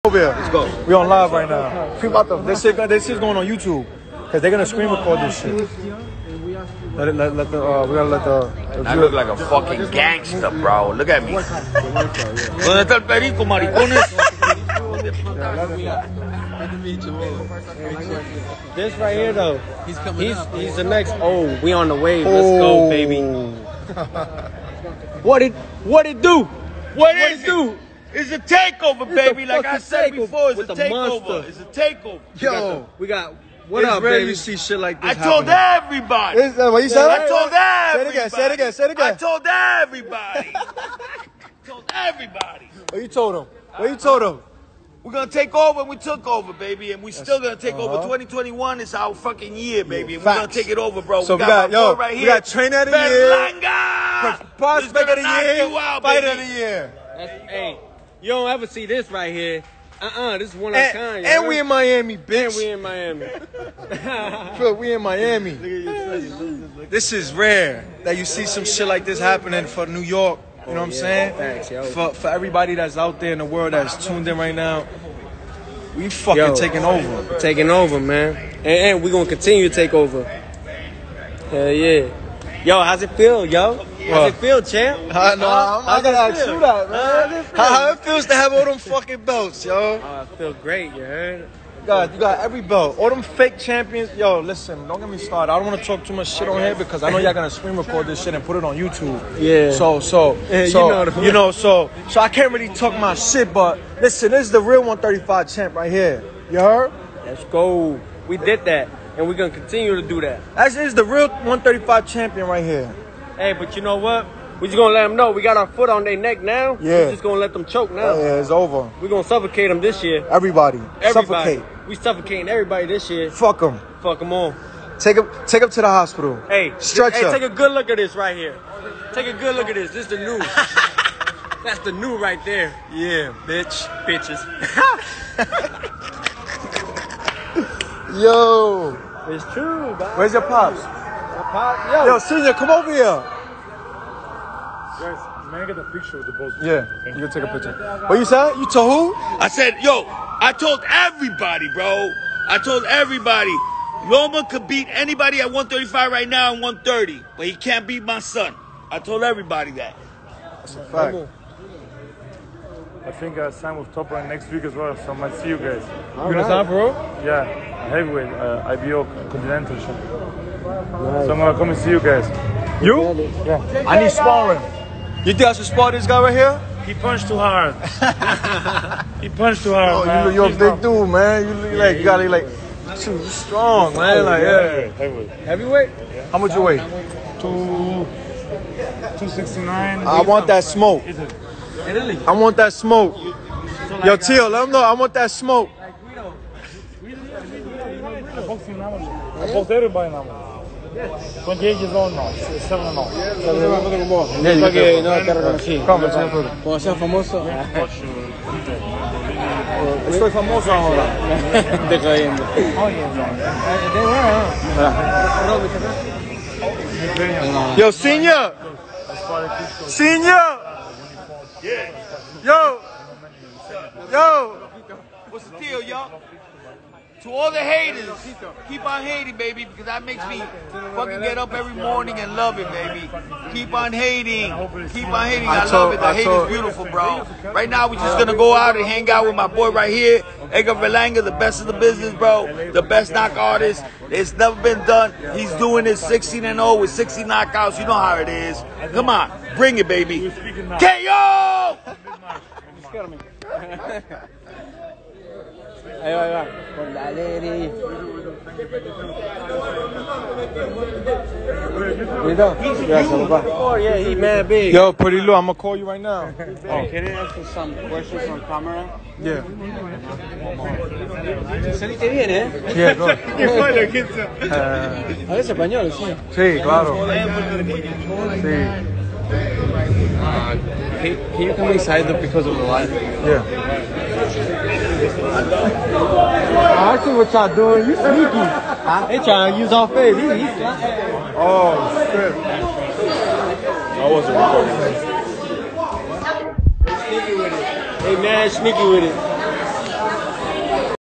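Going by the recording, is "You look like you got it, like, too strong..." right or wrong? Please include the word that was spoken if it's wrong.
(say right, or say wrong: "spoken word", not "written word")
right.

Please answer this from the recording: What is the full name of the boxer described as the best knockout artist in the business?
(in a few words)
Edgar Berlanga.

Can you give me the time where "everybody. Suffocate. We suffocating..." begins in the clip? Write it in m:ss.
2:01.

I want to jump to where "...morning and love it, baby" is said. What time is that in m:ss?
3:51.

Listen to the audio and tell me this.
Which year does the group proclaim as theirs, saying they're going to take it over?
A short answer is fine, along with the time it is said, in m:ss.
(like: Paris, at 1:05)
2021, at 0:48.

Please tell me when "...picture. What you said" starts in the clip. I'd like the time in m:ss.
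2:27.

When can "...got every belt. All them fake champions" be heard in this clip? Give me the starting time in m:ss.
1:32.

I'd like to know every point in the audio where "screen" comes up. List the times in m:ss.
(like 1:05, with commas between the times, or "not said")
0:04, 1:37.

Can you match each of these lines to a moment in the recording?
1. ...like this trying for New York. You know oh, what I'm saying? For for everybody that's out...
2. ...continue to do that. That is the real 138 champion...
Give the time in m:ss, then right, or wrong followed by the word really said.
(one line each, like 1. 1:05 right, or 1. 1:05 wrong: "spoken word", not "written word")
1. 1:08 wrong: "happening", not "trying"
2. 1:49 wrong: "135", not "138".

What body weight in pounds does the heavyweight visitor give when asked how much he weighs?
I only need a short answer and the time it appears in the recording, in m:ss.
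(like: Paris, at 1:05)
269, at 3:09.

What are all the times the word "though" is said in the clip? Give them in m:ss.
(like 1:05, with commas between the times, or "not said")
0:19, 4:42.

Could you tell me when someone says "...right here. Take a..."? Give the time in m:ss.
2:08.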